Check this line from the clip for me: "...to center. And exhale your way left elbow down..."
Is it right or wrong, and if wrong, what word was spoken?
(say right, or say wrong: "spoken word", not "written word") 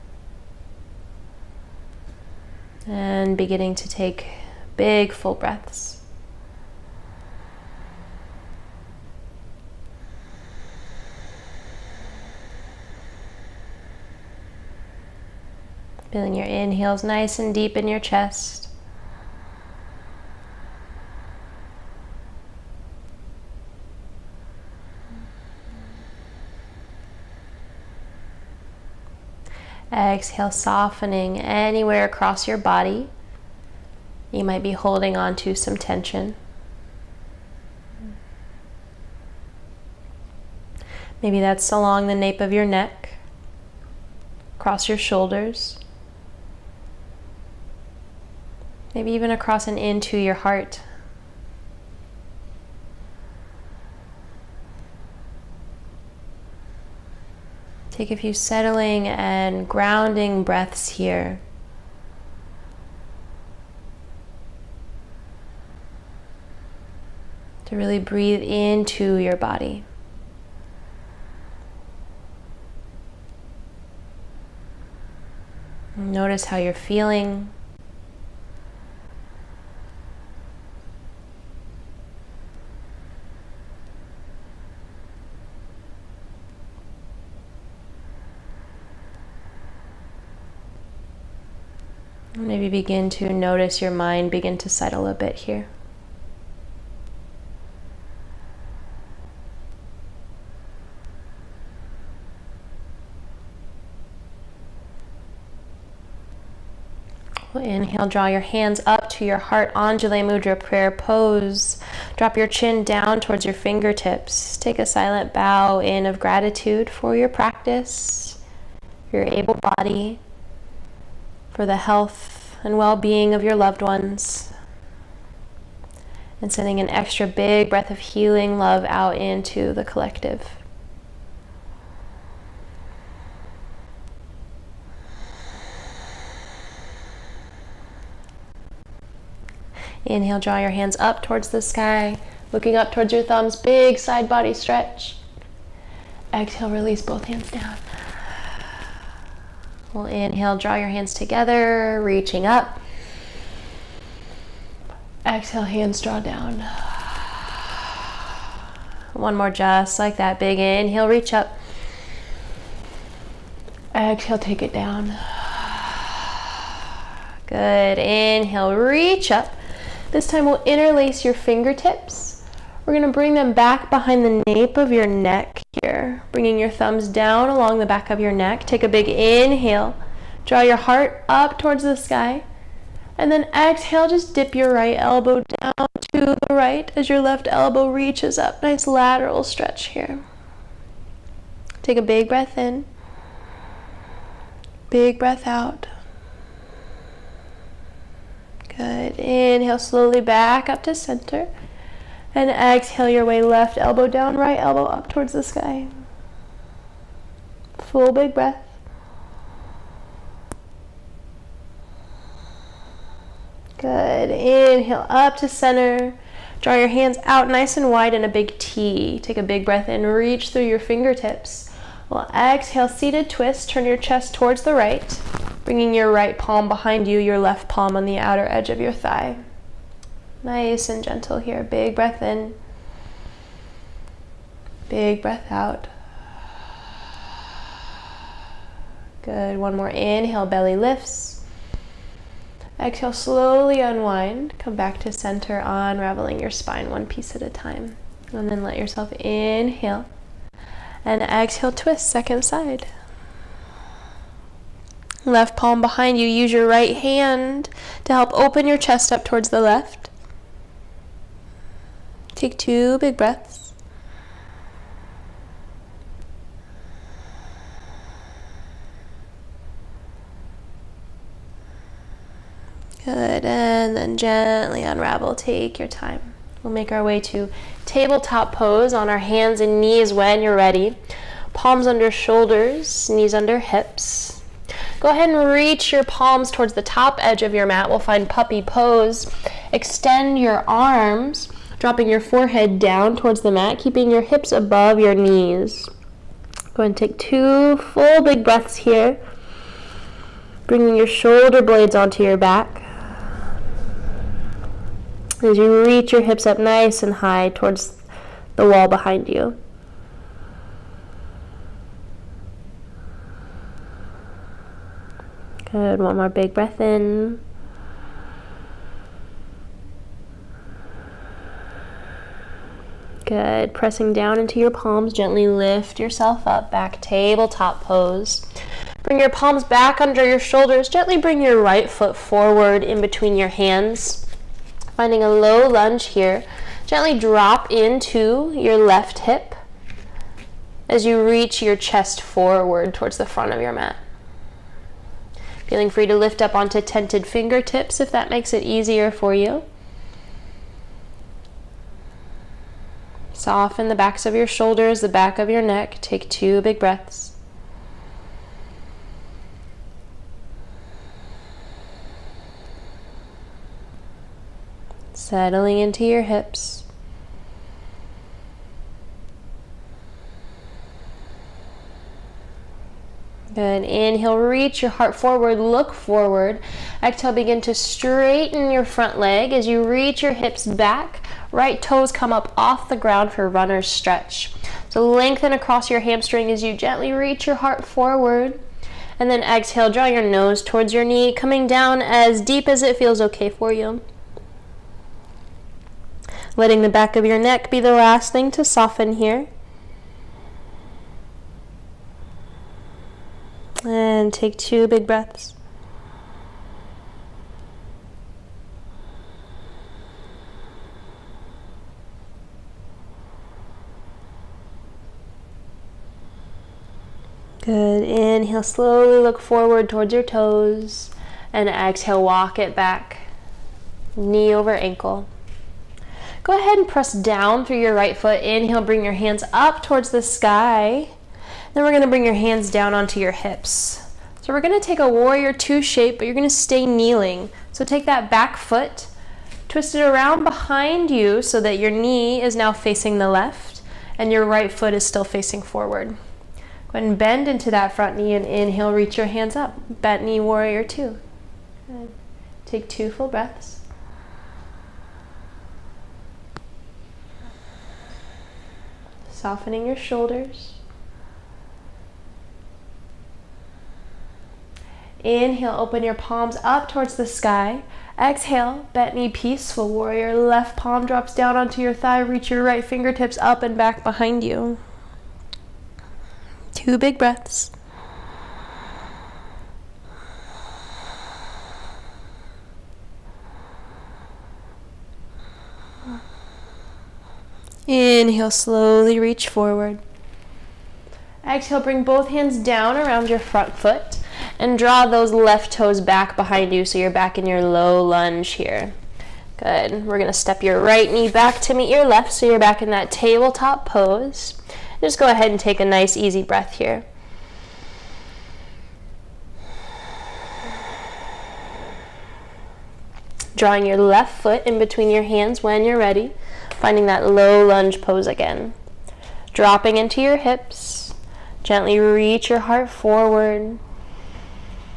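right.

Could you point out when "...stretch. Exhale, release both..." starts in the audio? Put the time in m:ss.
2:24.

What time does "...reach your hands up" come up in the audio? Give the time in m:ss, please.
7:28.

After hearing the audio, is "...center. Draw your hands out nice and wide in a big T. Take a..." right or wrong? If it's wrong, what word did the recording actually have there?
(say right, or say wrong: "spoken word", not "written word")
right.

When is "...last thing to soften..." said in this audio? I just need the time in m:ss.
6:37.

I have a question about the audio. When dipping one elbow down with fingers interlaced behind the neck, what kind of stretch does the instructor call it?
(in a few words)
lateral stretch.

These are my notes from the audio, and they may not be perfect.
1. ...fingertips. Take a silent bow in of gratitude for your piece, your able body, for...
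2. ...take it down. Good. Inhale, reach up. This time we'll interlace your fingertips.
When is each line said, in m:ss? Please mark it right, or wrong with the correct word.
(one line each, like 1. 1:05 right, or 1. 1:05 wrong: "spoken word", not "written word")
1. 1:53 wrong: "practice", not "piece"
2. 2:44 right.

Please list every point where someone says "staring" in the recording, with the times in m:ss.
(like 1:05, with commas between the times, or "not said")
not said.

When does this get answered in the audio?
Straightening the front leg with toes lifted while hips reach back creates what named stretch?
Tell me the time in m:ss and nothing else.
6:23.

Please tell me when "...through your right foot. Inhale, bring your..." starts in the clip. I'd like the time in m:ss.
7:07.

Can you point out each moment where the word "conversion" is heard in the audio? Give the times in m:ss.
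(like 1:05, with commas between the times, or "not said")
not said.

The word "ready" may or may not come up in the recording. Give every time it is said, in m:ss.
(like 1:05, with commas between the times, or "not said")
4:40, 8:35.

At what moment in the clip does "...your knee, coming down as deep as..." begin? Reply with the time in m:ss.
6:30.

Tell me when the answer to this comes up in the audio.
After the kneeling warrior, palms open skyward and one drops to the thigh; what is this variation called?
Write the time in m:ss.
7:48.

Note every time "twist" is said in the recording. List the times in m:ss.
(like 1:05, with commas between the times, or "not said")
3:43, 4:11, 7:19.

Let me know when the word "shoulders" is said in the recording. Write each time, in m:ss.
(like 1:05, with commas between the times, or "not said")
0:44, 4:42, 5:01, 5:30, 5:54, 7:39.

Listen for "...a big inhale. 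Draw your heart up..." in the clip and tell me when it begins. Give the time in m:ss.
2:58.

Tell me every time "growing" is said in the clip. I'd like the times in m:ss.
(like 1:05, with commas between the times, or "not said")
not said.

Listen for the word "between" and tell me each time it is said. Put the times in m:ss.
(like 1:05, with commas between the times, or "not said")
5:33, 8:34.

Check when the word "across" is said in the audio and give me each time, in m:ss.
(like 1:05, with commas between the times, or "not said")
0:32, 0:44, 0:49, 6:25.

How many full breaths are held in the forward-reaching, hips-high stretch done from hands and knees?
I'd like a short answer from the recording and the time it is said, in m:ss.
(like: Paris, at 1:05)
2, at 4:57.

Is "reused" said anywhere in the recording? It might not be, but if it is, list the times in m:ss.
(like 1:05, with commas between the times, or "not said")
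not said.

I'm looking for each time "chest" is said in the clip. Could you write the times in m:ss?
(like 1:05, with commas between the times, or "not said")
0:17, 3:43, 4:18, 5:41.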